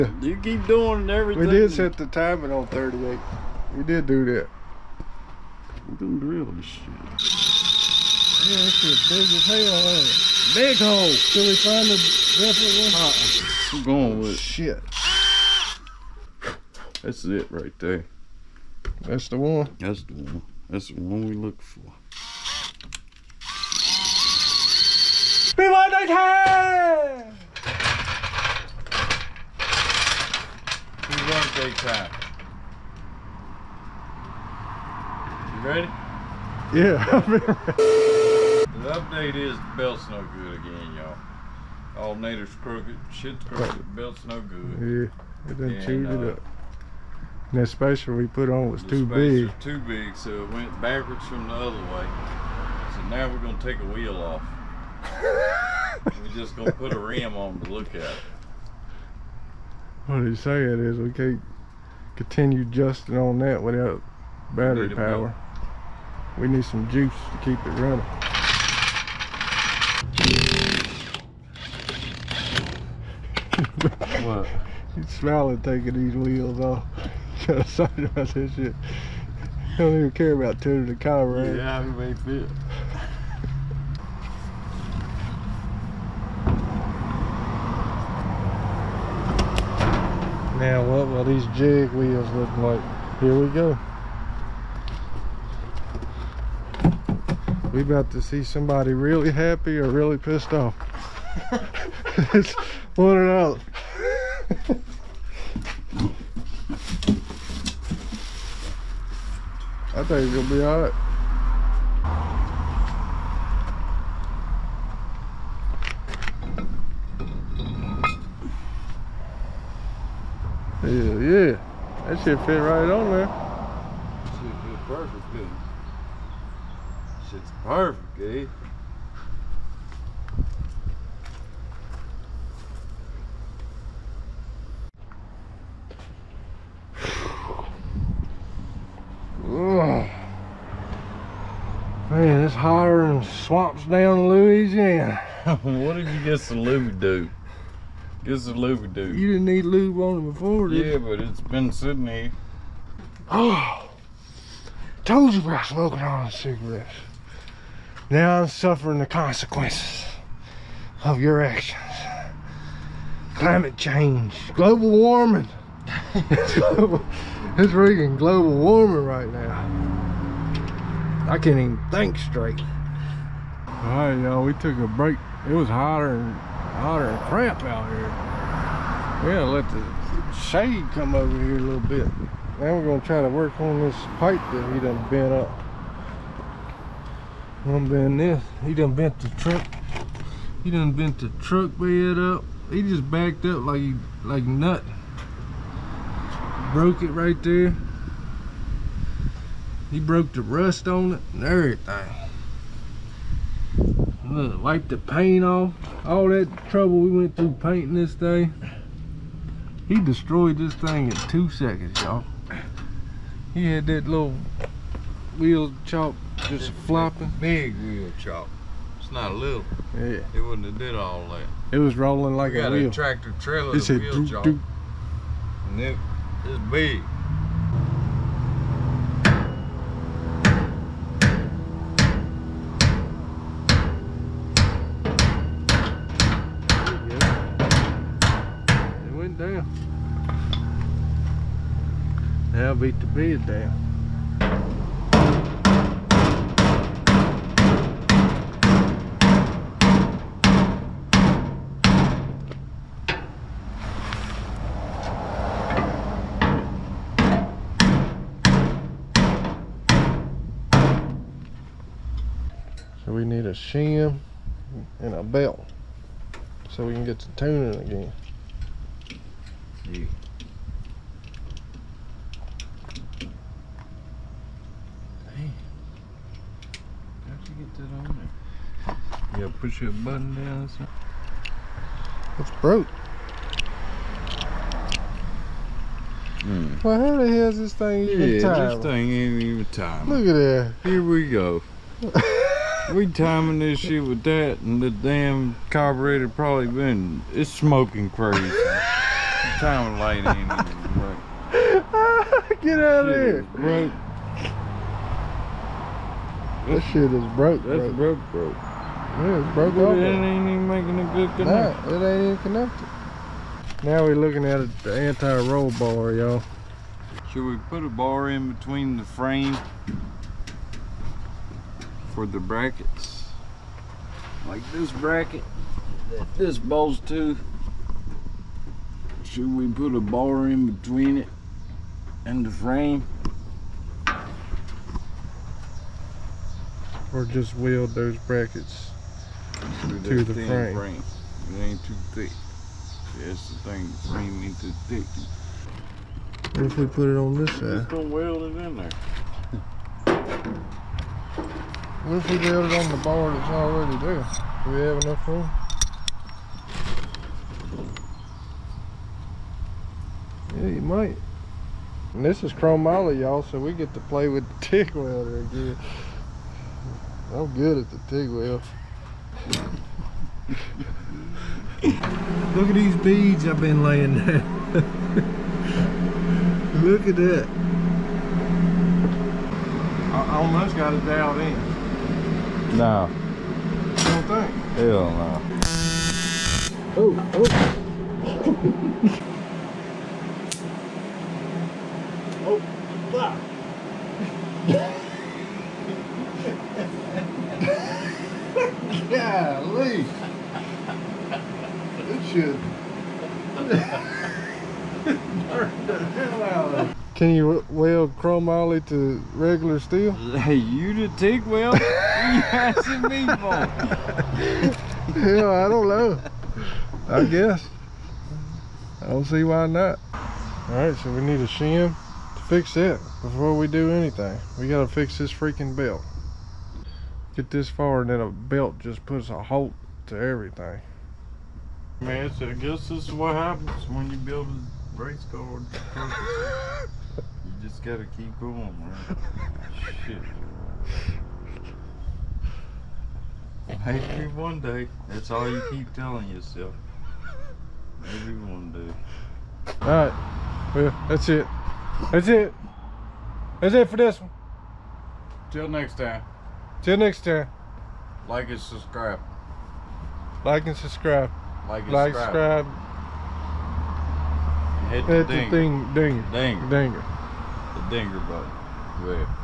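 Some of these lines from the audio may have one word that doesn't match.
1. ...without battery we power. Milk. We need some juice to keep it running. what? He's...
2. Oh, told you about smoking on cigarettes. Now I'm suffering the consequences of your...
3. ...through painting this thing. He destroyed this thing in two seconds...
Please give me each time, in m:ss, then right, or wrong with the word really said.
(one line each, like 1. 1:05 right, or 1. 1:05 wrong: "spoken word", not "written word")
1. 1:03 right
2. 2:33 right
3. 3:27 right.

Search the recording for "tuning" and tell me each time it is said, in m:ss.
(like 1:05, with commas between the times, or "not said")
1:20, 4:27.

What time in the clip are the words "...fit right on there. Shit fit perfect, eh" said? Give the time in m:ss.
2:02.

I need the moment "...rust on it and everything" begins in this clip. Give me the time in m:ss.
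3:20.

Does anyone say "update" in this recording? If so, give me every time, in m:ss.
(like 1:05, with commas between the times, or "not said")
0:38.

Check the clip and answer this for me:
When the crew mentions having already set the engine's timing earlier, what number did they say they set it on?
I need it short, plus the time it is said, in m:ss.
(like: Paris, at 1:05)
38, at 0:02.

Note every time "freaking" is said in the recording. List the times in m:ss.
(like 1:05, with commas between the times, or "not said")
2:47, 7:05.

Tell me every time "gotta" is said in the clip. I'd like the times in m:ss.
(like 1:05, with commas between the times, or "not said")
2:59, 7:04, 7:17.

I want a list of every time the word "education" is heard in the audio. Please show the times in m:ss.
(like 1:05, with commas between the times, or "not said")
not said.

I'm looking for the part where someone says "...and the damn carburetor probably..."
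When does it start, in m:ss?
4:54.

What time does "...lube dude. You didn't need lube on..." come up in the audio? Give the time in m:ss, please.
2:28.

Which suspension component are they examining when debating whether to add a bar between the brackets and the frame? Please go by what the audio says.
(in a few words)
Anti-roll bar.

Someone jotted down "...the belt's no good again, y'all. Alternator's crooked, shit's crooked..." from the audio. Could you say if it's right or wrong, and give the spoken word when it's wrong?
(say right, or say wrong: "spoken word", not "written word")
right.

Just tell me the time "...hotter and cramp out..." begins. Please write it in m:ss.
2:56.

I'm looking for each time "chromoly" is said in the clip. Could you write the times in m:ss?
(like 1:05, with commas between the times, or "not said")
6:02, 6:48.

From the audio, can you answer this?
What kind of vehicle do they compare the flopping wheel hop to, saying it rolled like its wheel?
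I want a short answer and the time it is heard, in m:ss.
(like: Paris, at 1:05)
A tractor trailer, at 3:42.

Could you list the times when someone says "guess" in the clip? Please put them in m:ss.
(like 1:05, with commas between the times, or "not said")
6:57, 7:12.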